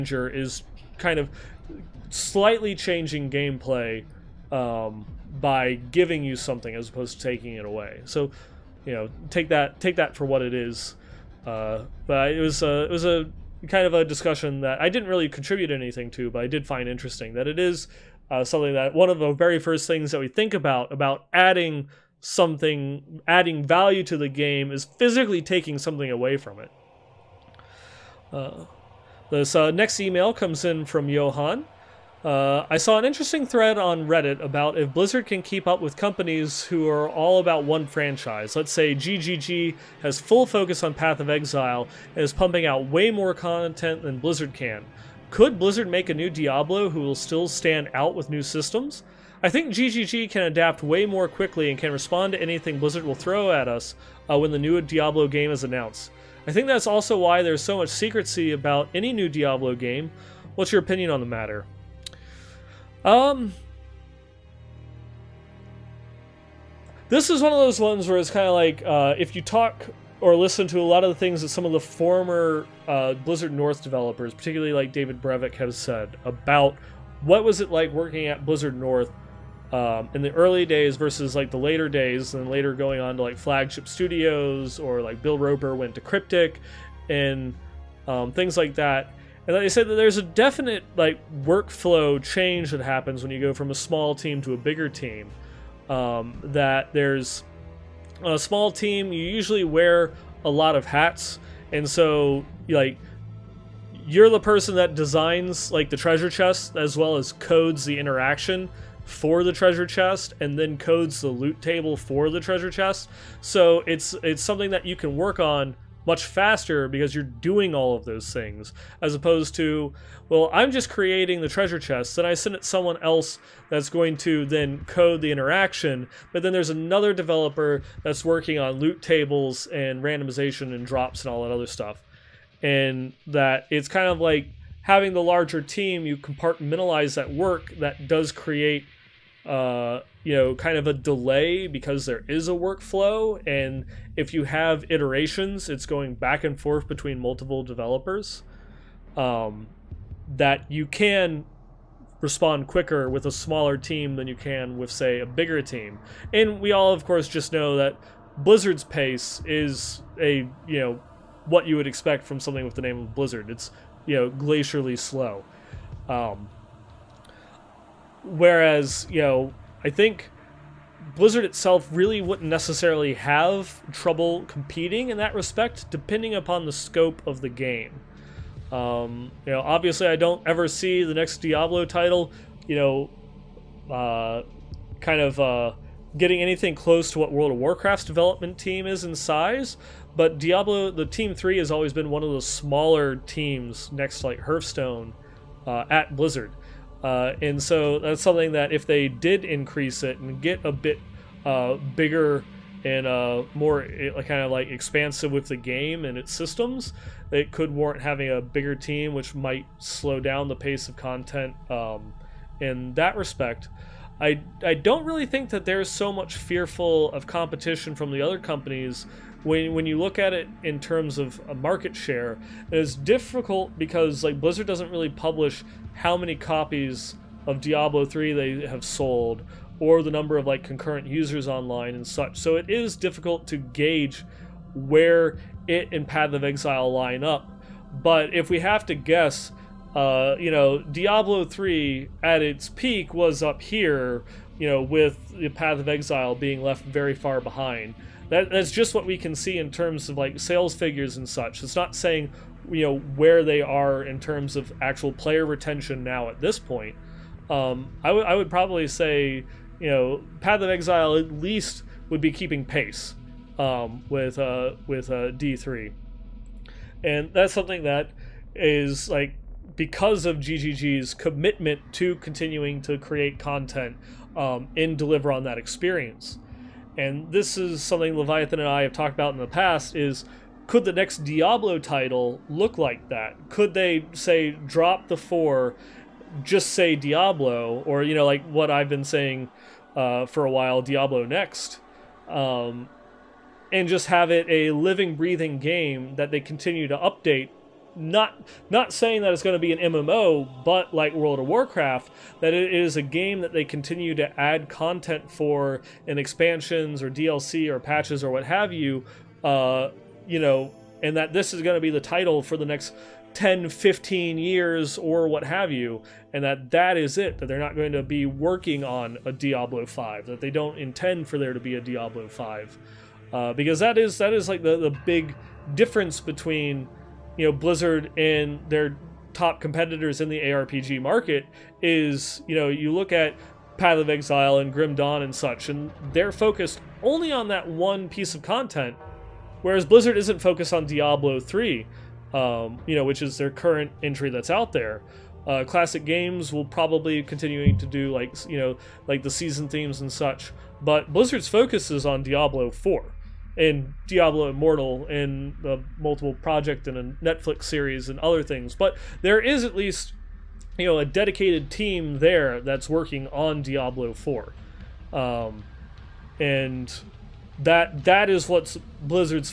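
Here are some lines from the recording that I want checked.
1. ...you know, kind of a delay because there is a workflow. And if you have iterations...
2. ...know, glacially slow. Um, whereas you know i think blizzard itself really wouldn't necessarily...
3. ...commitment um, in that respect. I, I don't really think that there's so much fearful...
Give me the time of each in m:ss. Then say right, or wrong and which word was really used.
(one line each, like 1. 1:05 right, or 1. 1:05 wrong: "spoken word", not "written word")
1. 2:20 right
2. 2:44 right
3. 3:30 wrong: "content", not "commitment".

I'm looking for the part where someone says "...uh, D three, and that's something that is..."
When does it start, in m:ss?
4:25.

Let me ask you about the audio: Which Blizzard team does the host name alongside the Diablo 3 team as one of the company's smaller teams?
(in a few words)
Hearthstone.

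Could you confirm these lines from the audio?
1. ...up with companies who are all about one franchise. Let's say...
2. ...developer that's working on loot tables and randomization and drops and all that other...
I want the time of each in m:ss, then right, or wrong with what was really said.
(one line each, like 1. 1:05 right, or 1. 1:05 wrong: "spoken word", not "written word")
1. 0:35 right
2. 2:07 right.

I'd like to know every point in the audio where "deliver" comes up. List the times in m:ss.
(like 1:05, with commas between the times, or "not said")
4:34.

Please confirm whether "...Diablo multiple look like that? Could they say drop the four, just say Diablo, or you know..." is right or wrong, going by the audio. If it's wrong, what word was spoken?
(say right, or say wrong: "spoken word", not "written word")
wrong: "title", not "multiple".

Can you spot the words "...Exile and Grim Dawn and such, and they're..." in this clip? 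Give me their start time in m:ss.
5:34.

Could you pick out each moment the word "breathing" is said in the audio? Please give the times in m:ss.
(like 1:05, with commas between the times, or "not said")
4:55.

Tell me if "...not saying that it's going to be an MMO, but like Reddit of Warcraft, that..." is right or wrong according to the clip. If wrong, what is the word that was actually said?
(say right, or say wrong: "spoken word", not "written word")
wrong: "World", not "Reddit".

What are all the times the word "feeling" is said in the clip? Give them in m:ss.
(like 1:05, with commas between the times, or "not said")
not said.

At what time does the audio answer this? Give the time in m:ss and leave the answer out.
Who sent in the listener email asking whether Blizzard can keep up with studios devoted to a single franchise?
0:31.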